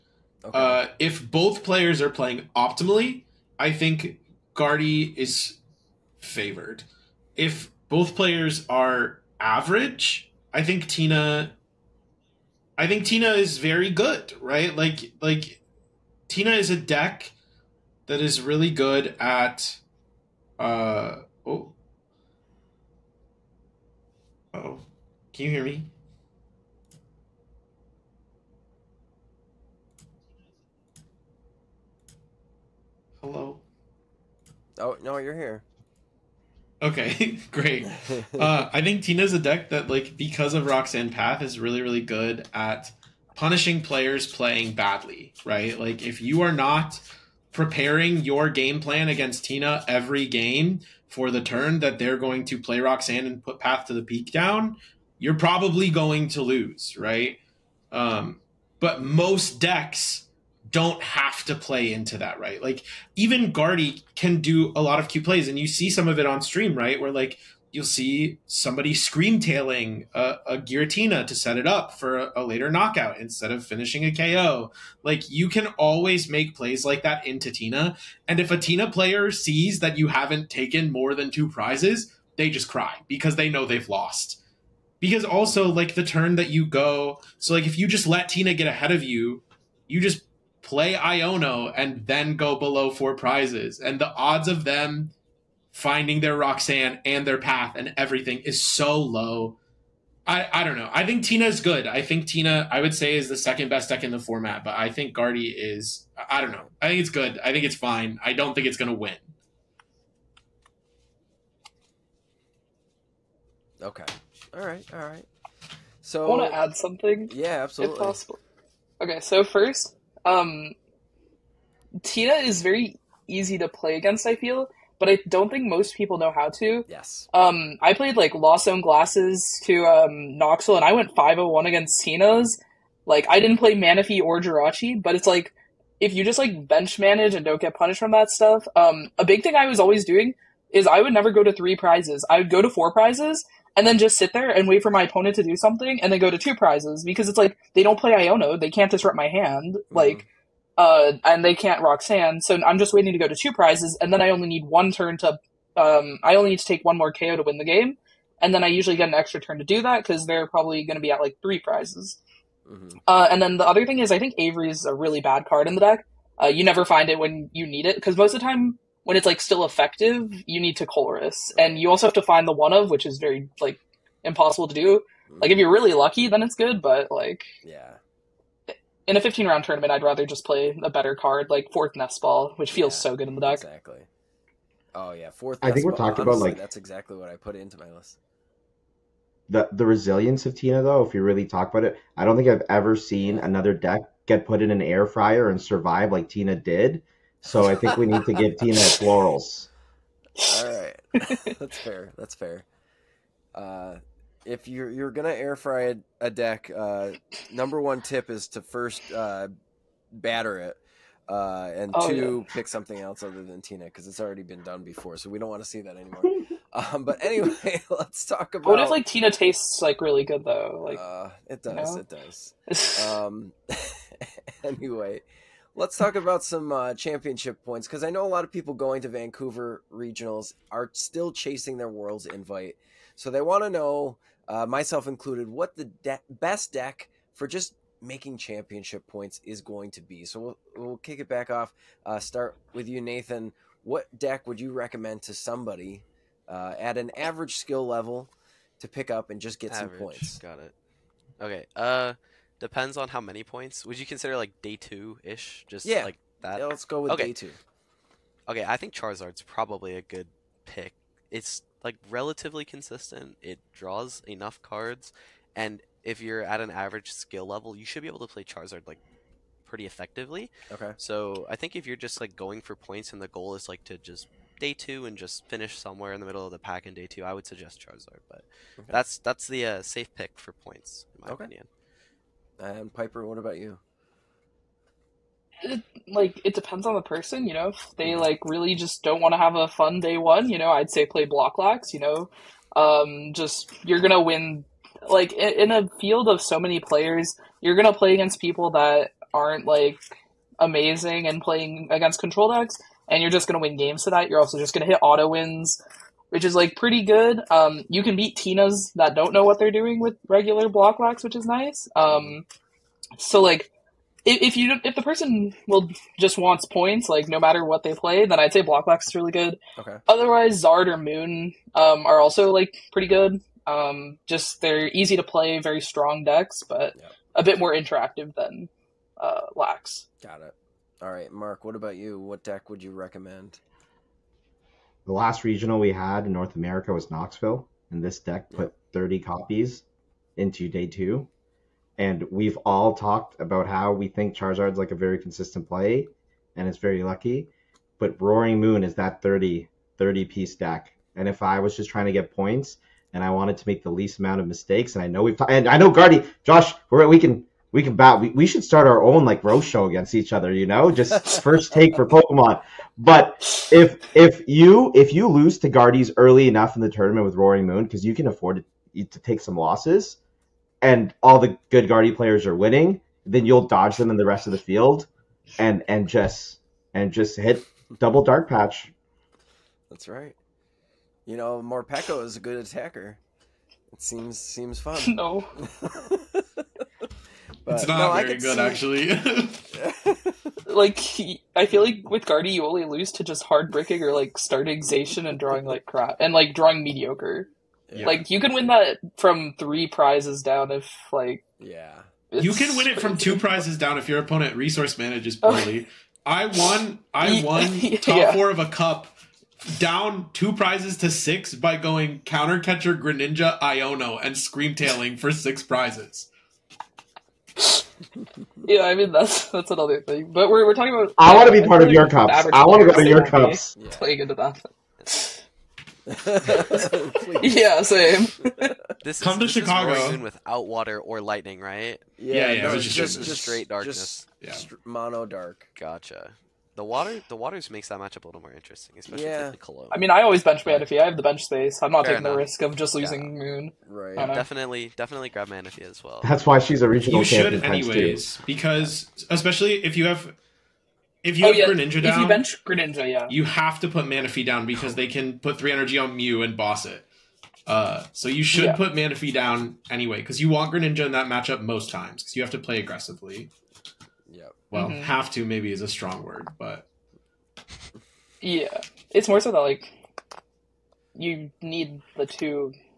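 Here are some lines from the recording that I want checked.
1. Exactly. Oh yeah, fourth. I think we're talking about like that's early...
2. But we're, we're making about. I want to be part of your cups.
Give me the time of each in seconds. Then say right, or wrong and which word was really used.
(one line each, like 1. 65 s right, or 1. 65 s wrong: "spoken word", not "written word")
1. 183 s wrong: "exactly", not "early"
2. 420 s wrong: "talking", not "making".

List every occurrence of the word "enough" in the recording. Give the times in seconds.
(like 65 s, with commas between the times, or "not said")
264 s, 366 s, 442 s.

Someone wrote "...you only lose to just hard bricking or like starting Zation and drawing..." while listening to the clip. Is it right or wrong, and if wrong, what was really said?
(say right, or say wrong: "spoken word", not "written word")
right.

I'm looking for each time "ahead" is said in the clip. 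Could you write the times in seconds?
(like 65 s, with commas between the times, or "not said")
88 s.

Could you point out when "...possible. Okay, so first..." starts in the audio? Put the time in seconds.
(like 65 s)
118 s.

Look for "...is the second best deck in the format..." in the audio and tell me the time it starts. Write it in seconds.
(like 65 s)
103 s.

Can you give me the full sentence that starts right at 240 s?
So we'll, we'll kick it back off.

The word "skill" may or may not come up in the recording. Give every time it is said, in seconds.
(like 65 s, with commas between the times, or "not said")
247 s, 267 s.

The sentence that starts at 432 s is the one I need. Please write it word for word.
Yeah, yeah, yeah no, it's just, just, just, straight darkness.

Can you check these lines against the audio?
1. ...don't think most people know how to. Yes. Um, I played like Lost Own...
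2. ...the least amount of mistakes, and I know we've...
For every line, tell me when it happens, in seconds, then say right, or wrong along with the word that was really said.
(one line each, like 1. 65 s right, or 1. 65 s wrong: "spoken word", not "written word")
1. 125 s right
2. 353 s right.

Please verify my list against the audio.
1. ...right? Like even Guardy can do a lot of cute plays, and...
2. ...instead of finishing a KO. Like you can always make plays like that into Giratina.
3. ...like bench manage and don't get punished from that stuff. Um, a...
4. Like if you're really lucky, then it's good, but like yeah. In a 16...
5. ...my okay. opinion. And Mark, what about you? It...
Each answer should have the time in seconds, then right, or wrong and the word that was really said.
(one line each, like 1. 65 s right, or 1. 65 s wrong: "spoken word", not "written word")
1. 62 s right
2. 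73 s wrong: "Tina", not "Giratina"
3. 136 s right
4. 175 s wrong: "15", not "16"
5. 281 s wrong: "Piper", not "Mark".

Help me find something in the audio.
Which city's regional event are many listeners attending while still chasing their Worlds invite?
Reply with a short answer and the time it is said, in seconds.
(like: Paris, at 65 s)
Vancouver, at 229 s.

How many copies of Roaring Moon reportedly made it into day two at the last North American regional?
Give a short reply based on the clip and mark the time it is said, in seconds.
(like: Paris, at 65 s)
30, at 338 s.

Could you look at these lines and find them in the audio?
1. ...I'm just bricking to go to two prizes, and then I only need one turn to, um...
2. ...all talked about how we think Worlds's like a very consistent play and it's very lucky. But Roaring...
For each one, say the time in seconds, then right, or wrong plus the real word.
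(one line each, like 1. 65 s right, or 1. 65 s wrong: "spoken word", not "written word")
1. 152 s wrong: "waiting", not "bricking"
2. 342 s wrong: "Charizard", not "Worlds".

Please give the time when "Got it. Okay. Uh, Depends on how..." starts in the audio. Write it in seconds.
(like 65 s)
250 s.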